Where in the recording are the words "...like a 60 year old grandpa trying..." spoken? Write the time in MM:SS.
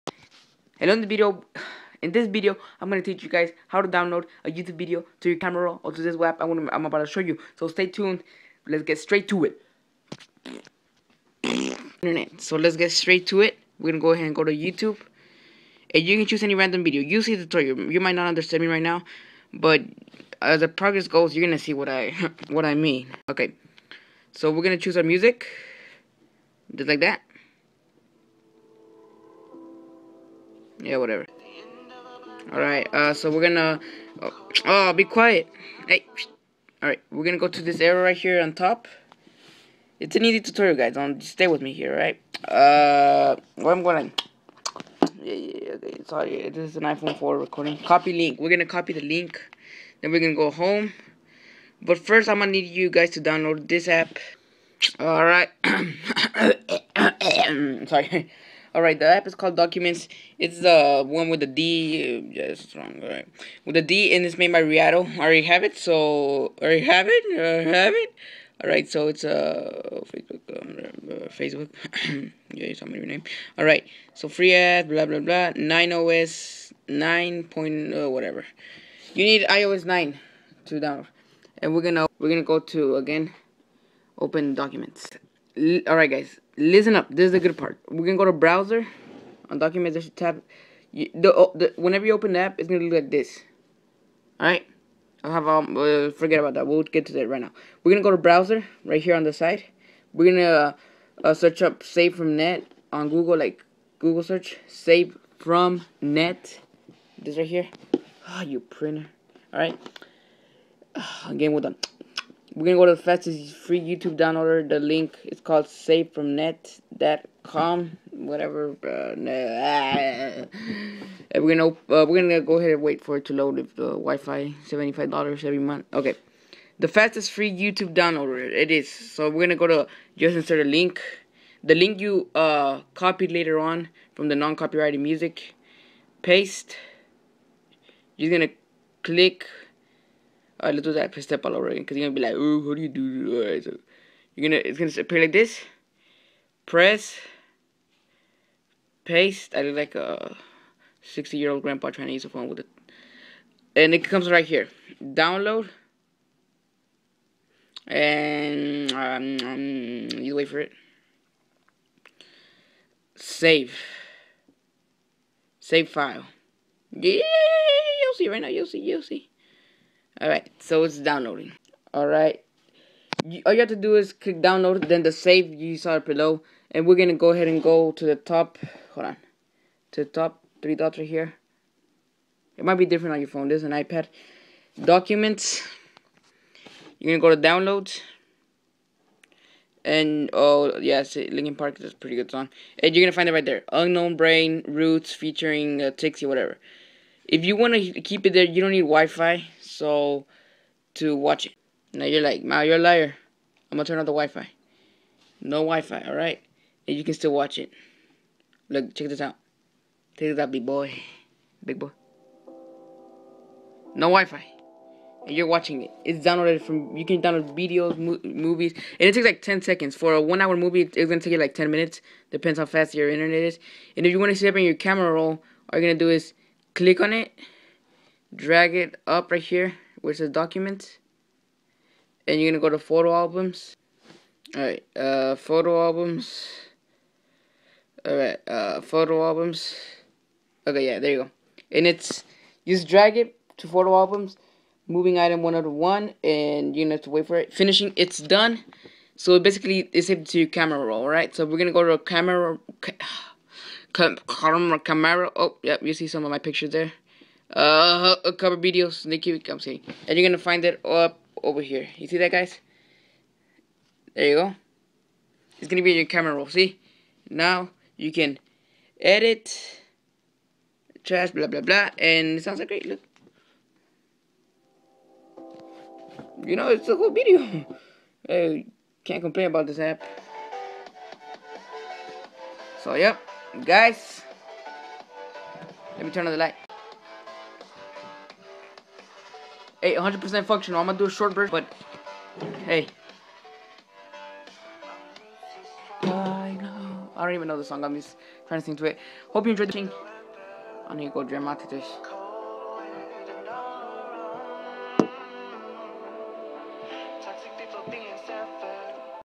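02:29.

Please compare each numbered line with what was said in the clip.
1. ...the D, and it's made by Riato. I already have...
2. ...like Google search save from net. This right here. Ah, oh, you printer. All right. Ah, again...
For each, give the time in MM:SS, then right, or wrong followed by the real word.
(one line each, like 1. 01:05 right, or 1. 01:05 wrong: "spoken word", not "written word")
1. 01:03 right
2. 01:43 right.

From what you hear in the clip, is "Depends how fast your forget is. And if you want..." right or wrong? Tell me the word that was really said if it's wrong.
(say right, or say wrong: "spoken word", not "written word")
wrong: "internet", not "forget".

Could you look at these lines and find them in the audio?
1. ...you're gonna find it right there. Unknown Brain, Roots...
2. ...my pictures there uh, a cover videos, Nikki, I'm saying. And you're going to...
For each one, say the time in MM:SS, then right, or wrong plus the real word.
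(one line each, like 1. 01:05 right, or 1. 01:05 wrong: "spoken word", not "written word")
1. 03:12 right
2. 04:16 right.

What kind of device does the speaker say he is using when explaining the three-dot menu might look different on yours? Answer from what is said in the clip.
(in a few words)
iPad.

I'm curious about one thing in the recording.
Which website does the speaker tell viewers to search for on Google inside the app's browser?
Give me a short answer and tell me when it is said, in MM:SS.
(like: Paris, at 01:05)
savefromnet.com, at 01:55.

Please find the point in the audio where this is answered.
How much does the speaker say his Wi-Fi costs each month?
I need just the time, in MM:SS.
02:04.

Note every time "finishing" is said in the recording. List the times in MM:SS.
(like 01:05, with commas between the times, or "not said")
04:07.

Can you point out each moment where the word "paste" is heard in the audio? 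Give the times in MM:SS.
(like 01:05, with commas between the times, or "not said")
02:16, 02:29.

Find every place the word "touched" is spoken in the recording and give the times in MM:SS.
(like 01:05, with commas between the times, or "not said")
not said.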